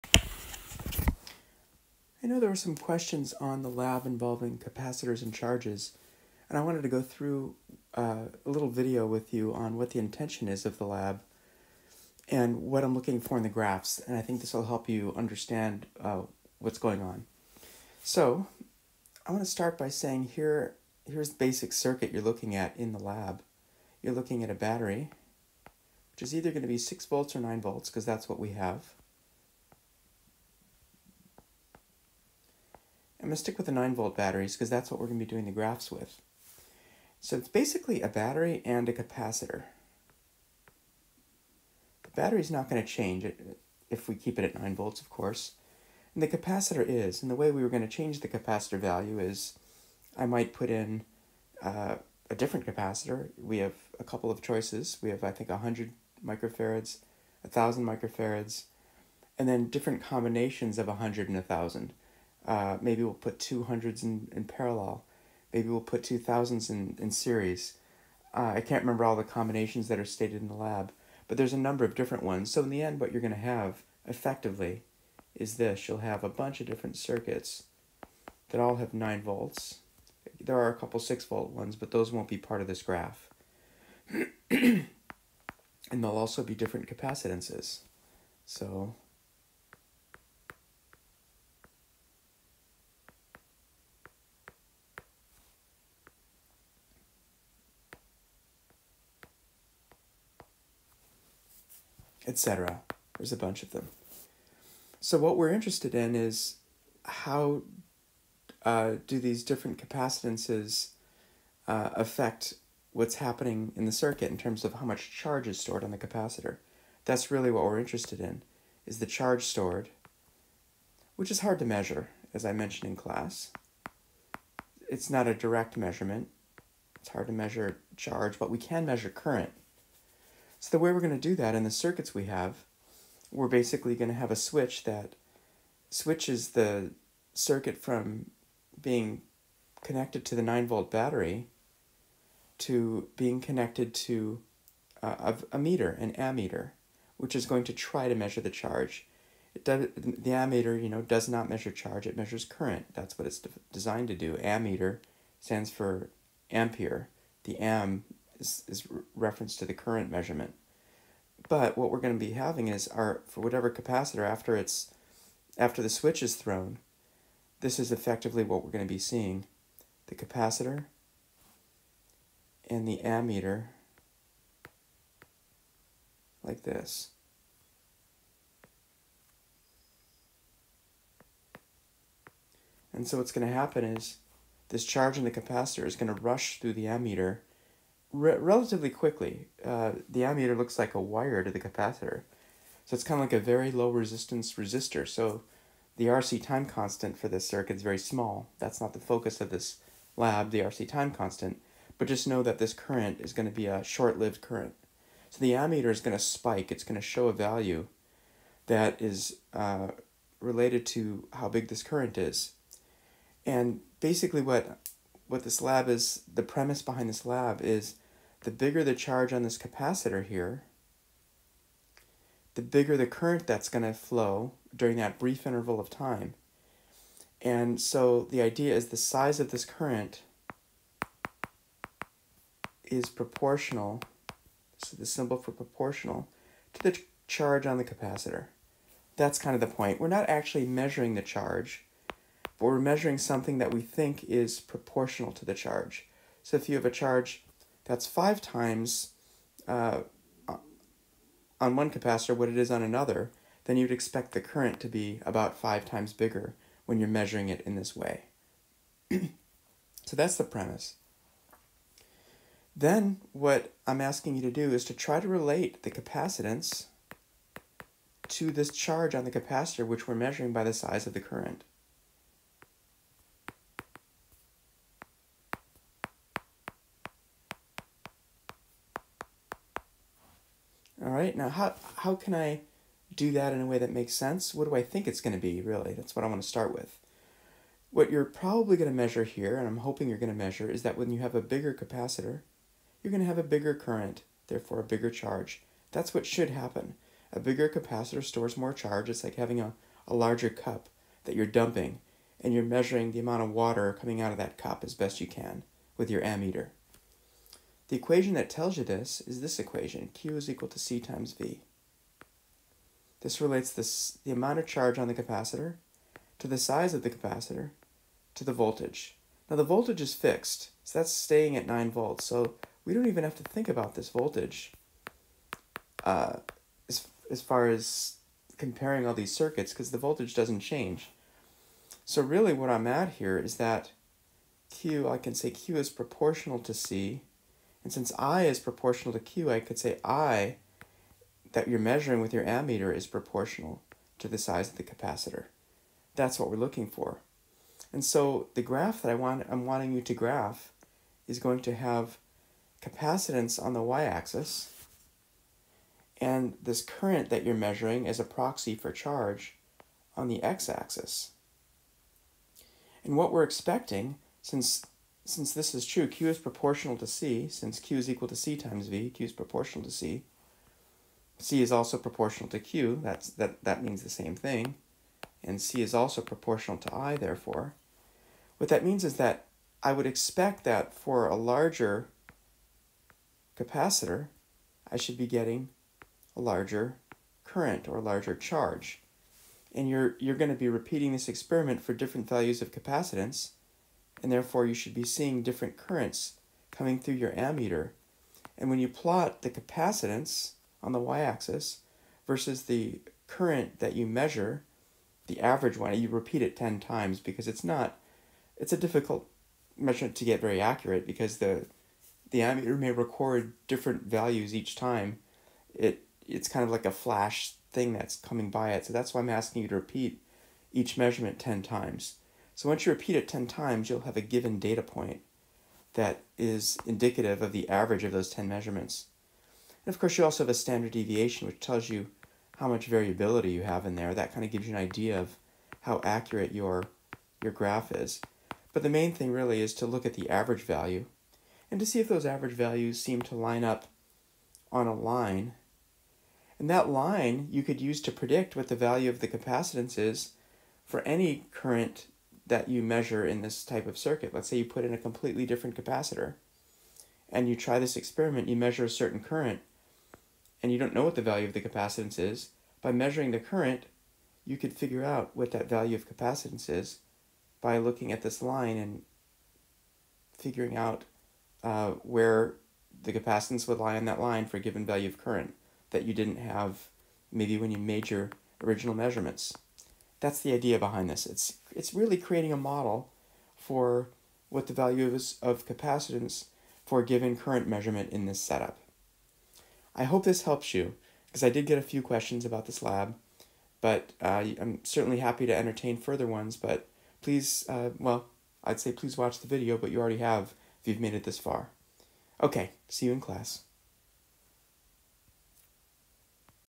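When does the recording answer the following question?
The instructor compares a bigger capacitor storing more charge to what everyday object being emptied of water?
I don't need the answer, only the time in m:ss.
5:00.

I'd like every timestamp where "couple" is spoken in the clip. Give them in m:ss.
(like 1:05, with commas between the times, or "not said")
0:54, 1:20.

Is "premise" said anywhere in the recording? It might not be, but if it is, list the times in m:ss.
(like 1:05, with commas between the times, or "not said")
3:36, 4:20.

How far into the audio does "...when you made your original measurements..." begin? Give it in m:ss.
7:57.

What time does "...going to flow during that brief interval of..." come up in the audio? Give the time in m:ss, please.
3:43.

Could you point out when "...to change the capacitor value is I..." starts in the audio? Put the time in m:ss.
0:47.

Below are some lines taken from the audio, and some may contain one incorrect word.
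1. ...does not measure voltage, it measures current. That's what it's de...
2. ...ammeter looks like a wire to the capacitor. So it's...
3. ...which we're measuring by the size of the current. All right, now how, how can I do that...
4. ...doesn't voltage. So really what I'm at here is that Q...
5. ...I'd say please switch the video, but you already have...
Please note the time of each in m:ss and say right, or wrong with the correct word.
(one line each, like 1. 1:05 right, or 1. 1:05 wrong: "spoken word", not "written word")
1. 2:31 wrong: "charge", not "voltage"
2. 3:10 right
3. 4:29 right
4. 5:30 wrong: "change", not "voltage"
5. 8:18 wrong: "watch", not "switch".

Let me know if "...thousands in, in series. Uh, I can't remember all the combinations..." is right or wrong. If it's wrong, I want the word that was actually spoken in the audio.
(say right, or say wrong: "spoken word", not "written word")
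right.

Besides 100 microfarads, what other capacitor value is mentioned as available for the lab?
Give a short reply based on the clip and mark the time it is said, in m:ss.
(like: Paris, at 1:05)
1,000 microfarads, at 0:57.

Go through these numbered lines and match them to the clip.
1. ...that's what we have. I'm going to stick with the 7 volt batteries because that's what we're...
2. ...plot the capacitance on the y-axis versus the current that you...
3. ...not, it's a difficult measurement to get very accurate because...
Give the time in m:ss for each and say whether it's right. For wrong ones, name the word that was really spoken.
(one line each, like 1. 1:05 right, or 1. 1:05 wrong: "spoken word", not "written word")
1. 0:28 wrong: "9", not "7"
2. 6:38 right
3. 6:47 right.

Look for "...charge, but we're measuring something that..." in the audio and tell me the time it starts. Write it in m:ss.
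4:01.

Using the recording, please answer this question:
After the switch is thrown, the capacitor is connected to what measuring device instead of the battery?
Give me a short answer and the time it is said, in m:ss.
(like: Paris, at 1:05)
An ammeter, at 2:25.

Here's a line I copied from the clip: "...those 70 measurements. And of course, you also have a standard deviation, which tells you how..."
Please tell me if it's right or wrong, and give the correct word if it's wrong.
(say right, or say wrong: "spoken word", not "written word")
wrong: "10", not "70".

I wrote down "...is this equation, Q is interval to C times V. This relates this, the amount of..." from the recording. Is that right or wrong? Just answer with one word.
wrong.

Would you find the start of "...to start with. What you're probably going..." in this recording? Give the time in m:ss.
4:46.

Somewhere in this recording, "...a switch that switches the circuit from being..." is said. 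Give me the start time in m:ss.
2:14.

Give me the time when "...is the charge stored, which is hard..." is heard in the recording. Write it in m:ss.
1:58.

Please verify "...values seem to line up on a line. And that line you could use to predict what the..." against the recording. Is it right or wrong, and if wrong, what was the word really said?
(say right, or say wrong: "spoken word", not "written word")
right.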